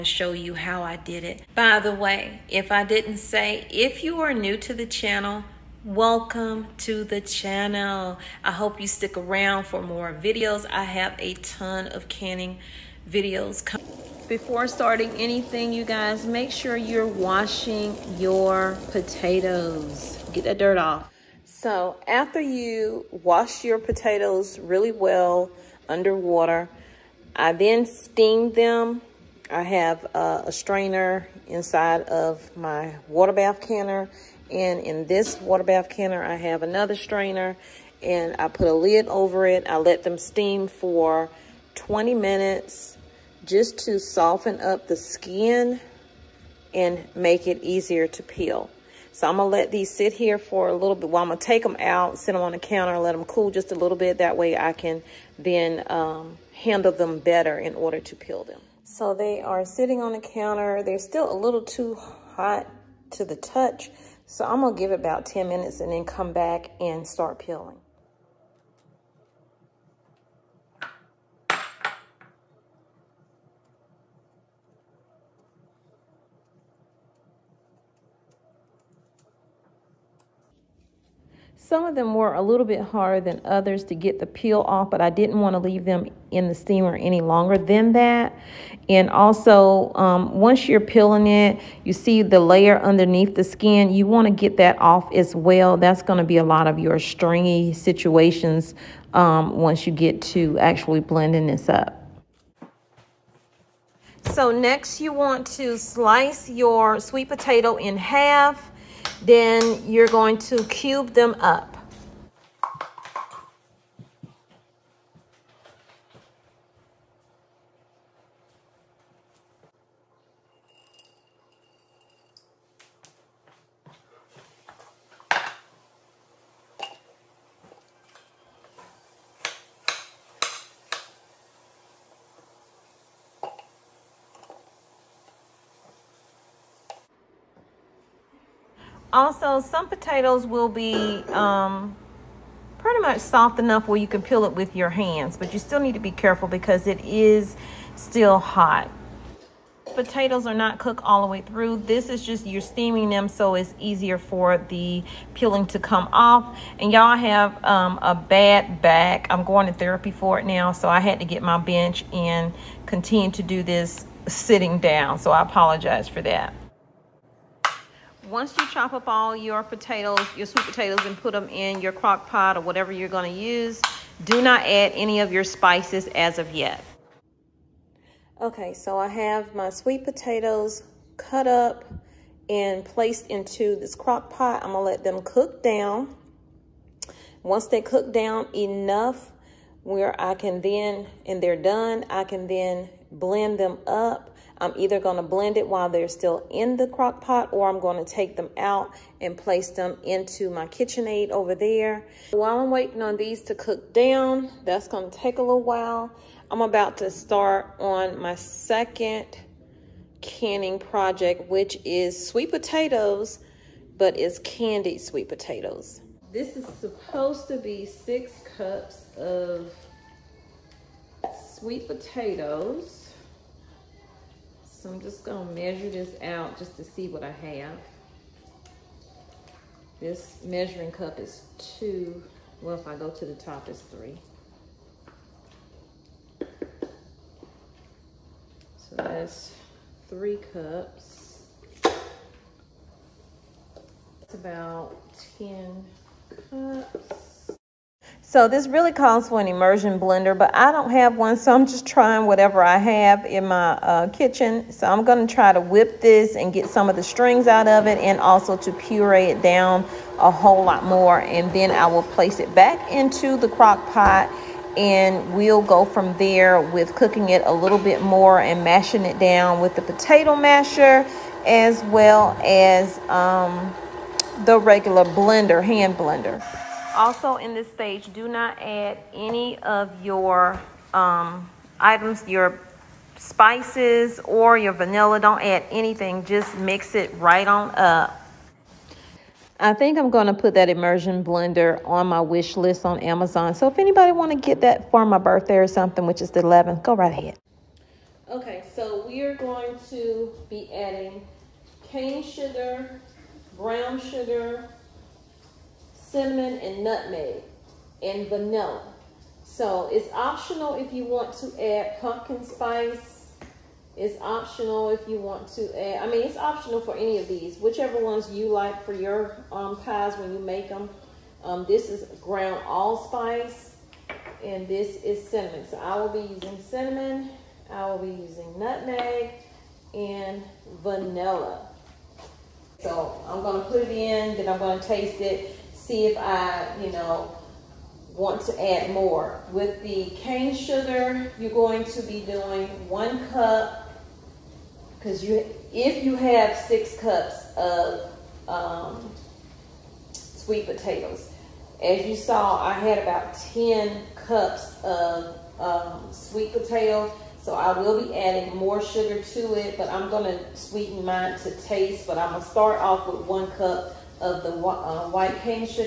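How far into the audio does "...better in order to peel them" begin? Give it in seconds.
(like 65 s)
57 s.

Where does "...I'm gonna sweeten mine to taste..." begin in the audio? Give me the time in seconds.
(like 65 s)
359 s.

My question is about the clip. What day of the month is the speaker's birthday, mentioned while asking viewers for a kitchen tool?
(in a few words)
11th.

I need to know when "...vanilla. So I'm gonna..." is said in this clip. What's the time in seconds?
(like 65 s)
330 s.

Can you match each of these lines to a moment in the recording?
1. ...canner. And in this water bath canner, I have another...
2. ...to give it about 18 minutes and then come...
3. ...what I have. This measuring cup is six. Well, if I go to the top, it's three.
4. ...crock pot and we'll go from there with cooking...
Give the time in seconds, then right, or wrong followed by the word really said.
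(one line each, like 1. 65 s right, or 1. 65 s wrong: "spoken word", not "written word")
1. 33 s right
2. 64 s wrong: "10", not "18"
3. 227 s wrong: "two", not "six"
4. 263 s right.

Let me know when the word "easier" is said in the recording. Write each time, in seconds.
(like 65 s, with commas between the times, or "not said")
47 s, 153 s.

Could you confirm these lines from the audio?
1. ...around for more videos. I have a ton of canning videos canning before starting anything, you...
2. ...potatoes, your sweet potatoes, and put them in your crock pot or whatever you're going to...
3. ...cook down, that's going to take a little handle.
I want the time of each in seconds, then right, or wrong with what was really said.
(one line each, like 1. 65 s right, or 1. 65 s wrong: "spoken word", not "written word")
1. 9 s wrong: "coming", not "canning"
2. 169 s right
3. 203 s wrong: "while", not "handle".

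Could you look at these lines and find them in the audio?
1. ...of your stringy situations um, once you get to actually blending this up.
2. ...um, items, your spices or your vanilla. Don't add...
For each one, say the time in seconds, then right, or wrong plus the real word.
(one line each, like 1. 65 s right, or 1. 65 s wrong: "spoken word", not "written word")
1. 96 s right
2. 280 s right.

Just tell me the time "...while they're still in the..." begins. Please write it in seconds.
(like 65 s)
195 s.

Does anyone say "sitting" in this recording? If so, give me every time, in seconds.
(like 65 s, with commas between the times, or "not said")
59 s, 164 s.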